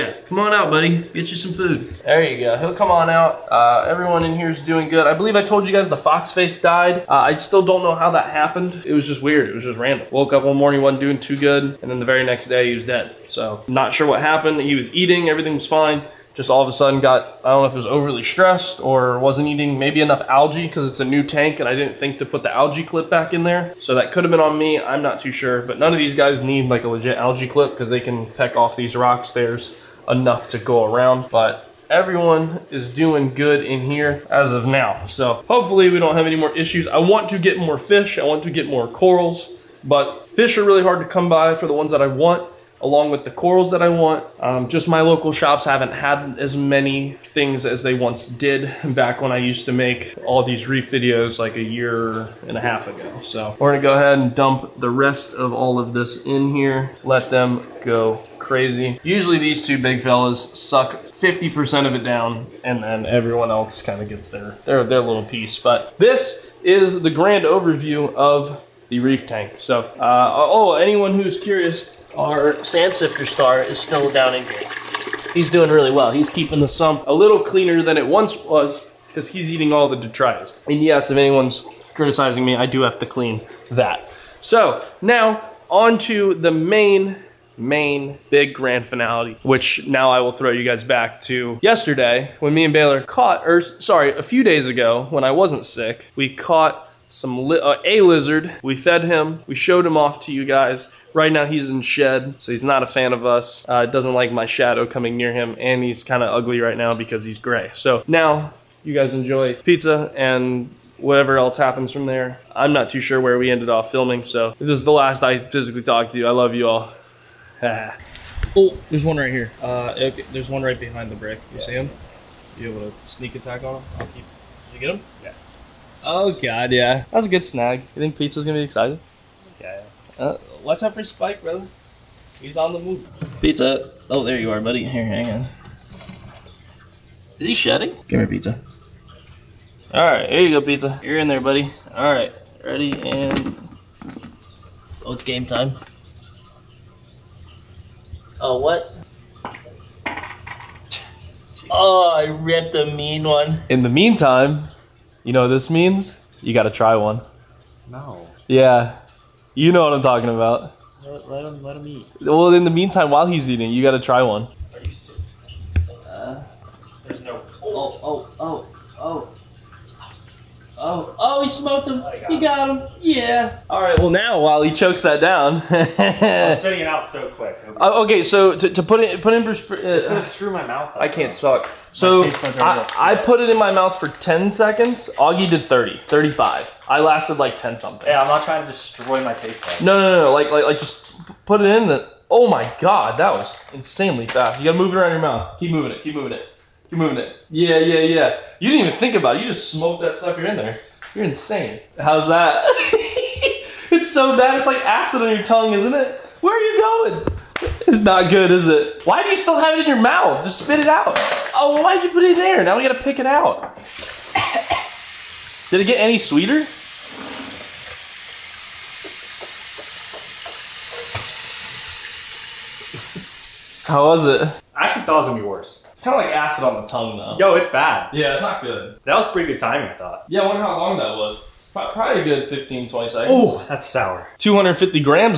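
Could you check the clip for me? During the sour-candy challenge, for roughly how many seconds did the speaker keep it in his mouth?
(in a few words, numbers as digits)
10.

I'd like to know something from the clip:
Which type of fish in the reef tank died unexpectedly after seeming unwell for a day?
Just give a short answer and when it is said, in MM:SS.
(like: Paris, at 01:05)
Fox face, at 00:05.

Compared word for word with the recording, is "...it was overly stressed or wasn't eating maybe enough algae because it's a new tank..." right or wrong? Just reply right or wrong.
right.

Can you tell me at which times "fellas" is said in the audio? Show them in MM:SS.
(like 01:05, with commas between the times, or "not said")
01:00.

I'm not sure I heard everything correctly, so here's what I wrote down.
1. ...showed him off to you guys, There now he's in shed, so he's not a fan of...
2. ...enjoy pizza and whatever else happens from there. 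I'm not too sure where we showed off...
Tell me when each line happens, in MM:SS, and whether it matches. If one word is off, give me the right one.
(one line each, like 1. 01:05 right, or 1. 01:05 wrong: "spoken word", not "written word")
1. 01:39 wrong: "Right", not "There"
2. 01:49 wrong: "ended", not "showed".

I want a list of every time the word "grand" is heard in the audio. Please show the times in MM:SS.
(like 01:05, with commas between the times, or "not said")
01:07, 01:28.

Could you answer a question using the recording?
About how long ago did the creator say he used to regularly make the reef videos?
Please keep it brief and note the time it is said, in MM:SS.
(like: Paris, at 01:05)
A year and a half, at 00:51.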